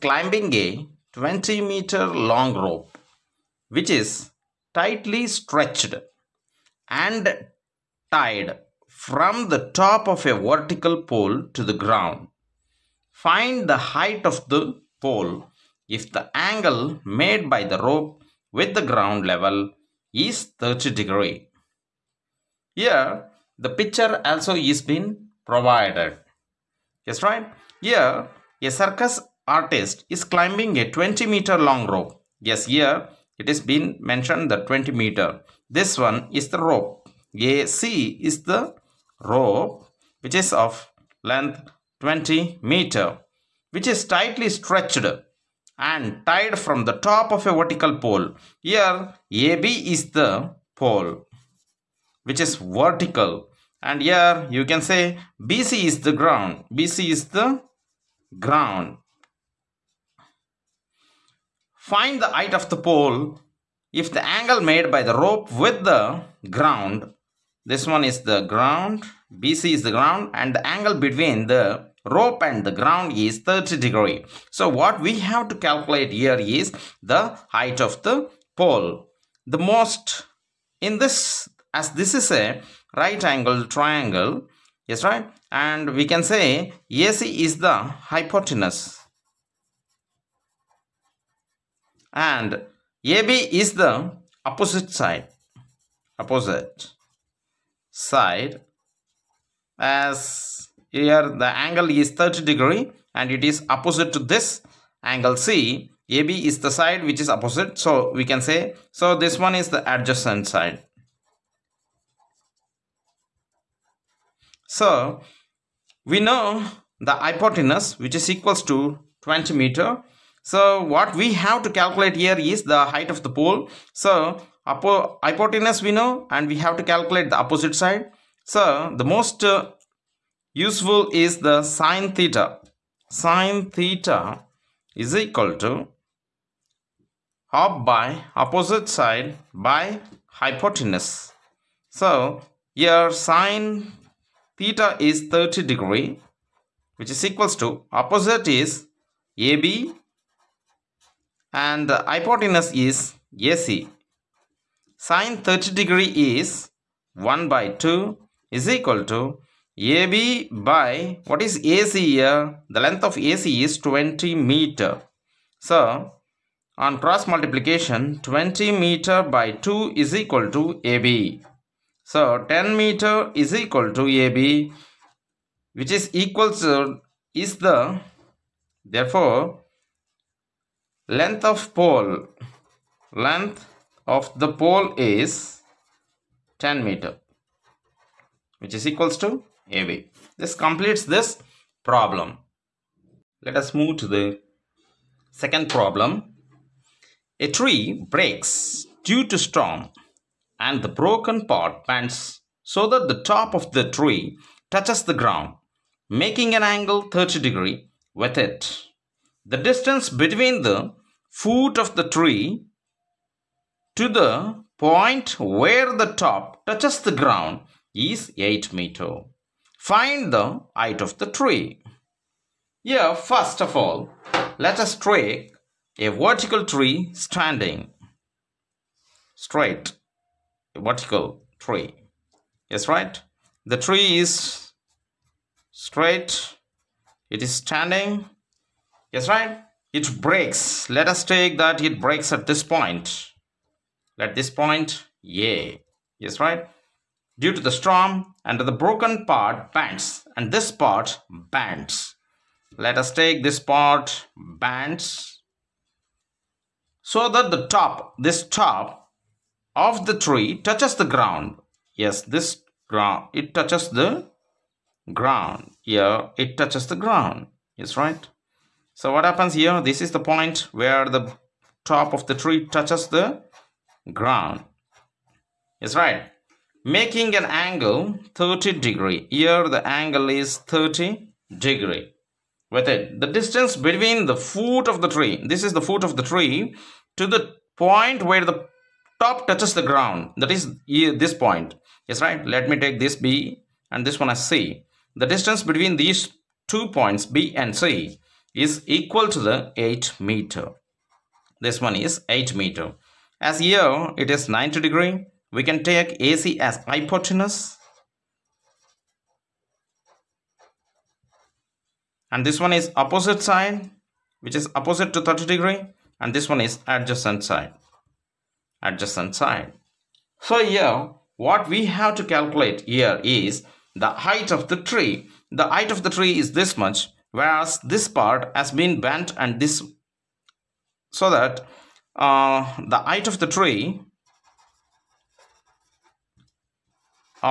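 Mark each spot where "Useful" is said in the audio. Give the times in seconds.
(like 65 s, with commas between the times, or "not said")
130 s.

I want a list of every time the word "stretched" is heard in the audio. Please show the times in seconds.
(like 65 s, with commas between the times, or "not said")
5 s, 44 s.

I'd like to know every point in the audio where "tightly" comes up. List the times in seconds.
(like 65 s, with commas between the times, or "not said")
4 s, 44 s.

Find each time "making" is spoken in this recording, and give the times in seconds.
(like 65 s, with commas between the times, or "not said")
206 s, 276 s.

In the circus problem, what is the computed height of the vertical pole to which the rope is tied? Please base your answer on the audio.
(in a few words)
10 meters.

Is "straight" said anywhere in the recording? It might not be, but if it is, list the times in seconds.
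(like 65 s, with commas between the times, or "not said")
229 s, 235 s.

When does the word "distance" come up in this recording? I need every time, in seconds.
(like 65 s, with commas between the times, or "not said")
209 s, 283 s, 295 s.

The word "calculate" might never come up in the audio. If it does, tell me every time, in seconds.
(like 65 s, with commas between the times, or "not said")
75 s, 121 s, 126 s, 322 s.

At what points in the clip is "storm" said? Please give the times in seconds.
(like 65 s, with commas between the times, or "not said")
199 s, 247 s.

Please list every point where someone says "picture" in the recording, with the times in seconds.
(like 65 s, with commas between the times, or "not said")
23 s.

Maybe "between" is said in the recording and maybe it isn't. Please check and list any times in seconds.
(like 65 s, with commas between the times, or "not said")
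70 s, 210 s, 283 s, 295 s.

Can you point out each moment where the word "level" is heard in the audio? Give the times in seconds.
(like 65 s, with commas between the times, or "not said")
19 s.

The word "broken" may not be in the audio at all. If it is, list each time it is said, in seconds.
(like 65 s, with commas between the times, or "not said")
200 s, 248 s.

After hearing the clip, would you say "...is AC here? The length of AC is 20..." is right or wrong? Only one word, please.
right.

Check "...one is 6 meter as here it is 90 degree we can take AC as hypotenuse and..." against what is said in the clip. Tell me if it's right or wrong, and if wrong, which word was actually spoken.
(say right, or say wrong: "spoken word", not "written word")
wrong: "8", not "6".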